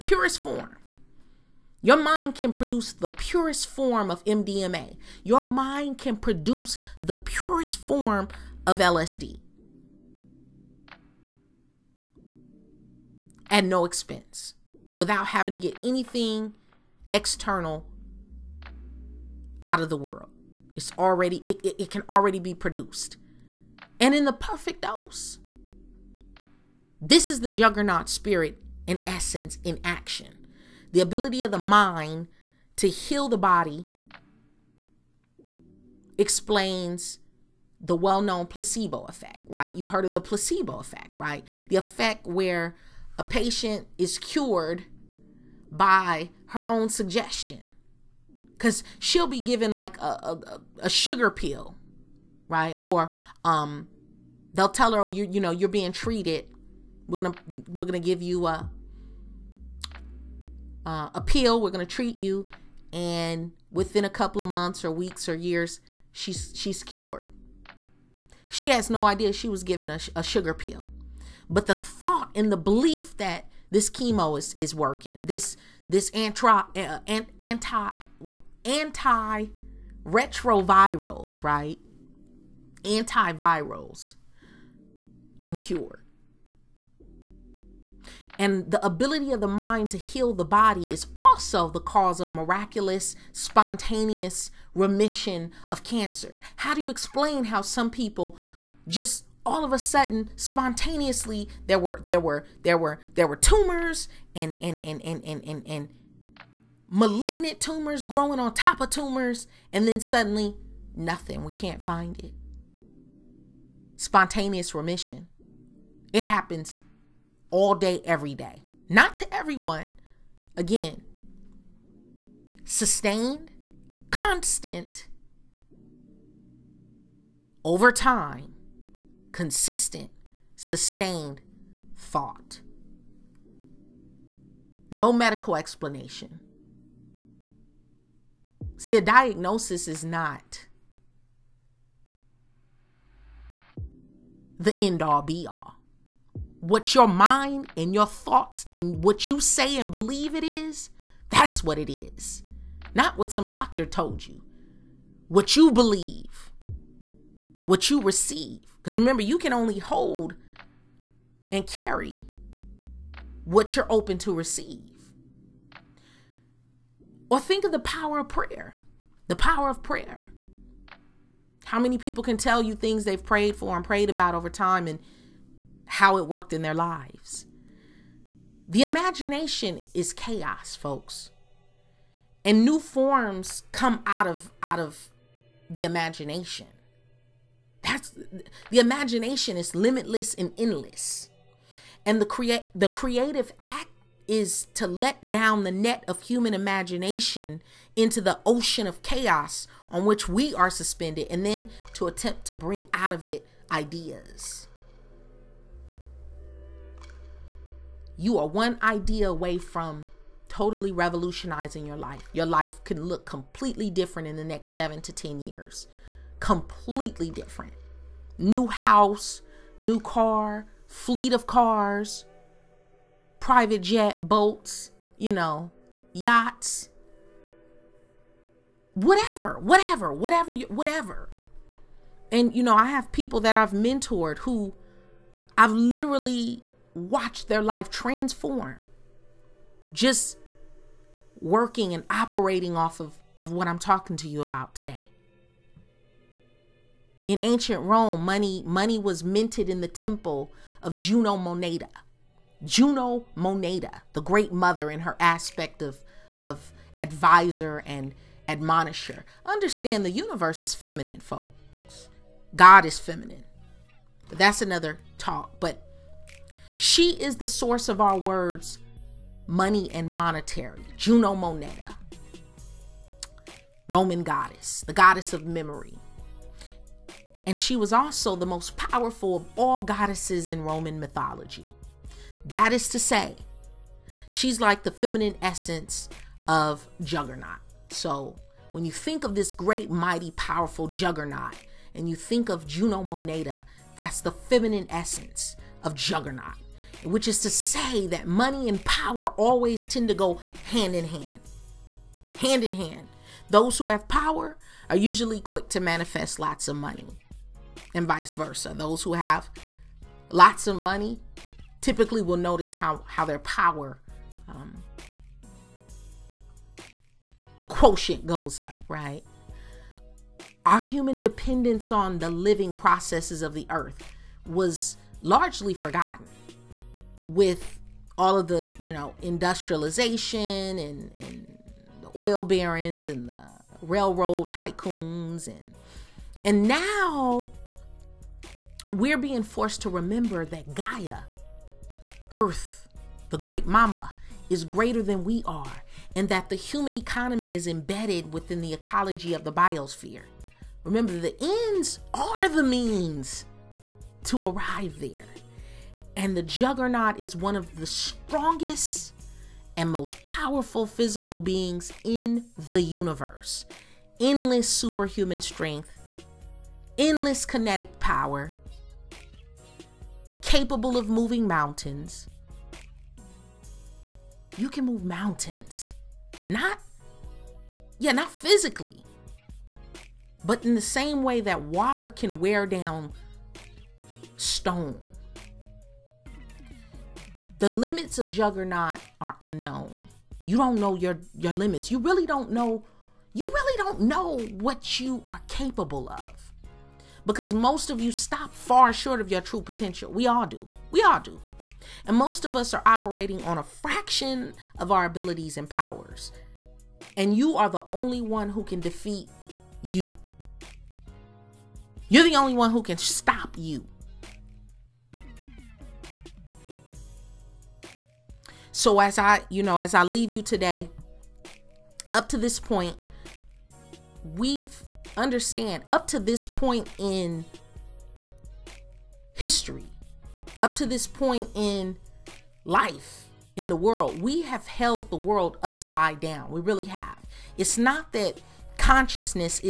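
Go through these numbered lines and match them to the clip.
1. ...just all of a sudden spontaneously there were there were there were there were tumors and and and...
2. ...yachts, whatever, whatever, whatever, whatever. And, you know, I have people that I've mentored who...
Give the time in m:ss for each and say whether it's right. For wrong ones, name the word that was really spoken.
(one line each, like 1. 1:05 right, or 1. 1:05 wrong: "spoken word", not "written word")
1. 1:38 right
2. 3:46 right.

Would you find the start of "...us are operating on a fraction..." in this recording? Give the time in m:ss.
6:42.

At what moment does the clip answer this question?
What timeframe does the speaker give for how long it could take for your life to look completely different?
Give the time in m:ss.
3:34.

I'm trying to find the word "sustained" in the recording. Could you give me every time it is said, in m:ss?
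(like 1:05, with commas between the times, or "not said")
2:02, 2:10.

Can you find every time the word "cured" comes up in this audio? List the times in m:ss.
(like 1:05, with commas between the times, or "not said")
0:44, 1:06, 1:25.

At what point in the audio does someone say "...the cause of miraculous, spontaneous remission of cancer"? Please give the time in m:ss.
1:31.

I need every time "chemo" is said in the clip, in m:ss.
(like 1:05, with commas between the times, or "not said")
1:13.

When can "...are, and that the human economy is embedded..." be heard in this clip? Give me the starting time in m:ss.
5:45.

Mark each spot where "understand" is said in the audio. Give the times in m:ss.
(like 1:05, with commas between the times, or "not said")
4:19, 7:05.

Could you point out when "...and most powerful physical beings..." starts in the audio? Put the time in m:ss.
5:59.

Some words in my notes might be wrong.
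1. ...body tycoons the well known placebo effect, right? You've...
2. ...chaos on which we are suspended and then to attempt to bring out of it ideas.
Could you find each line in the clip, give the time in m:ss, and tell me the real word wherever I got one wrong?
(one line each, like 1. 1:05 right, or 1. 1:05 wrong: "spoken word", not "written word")
1. 0:33 wrong: "explains", not "tycoons"
2. 3:19 right.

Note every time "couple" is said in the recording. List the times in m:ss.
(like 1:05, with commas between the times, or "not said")
1:04.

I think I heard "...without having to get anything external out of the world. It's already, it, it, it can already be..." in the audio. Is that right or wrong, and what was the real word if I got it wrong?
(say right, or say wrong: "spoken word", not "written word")
right.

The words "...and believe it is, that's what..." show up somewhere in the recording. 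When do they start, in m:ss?
2:29.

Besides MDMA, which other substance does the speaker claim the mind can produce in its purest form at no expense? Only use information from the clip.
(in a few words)
LSD.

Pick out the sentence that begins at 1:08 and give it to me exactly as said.
She has no idea she was given a, a sugar pill.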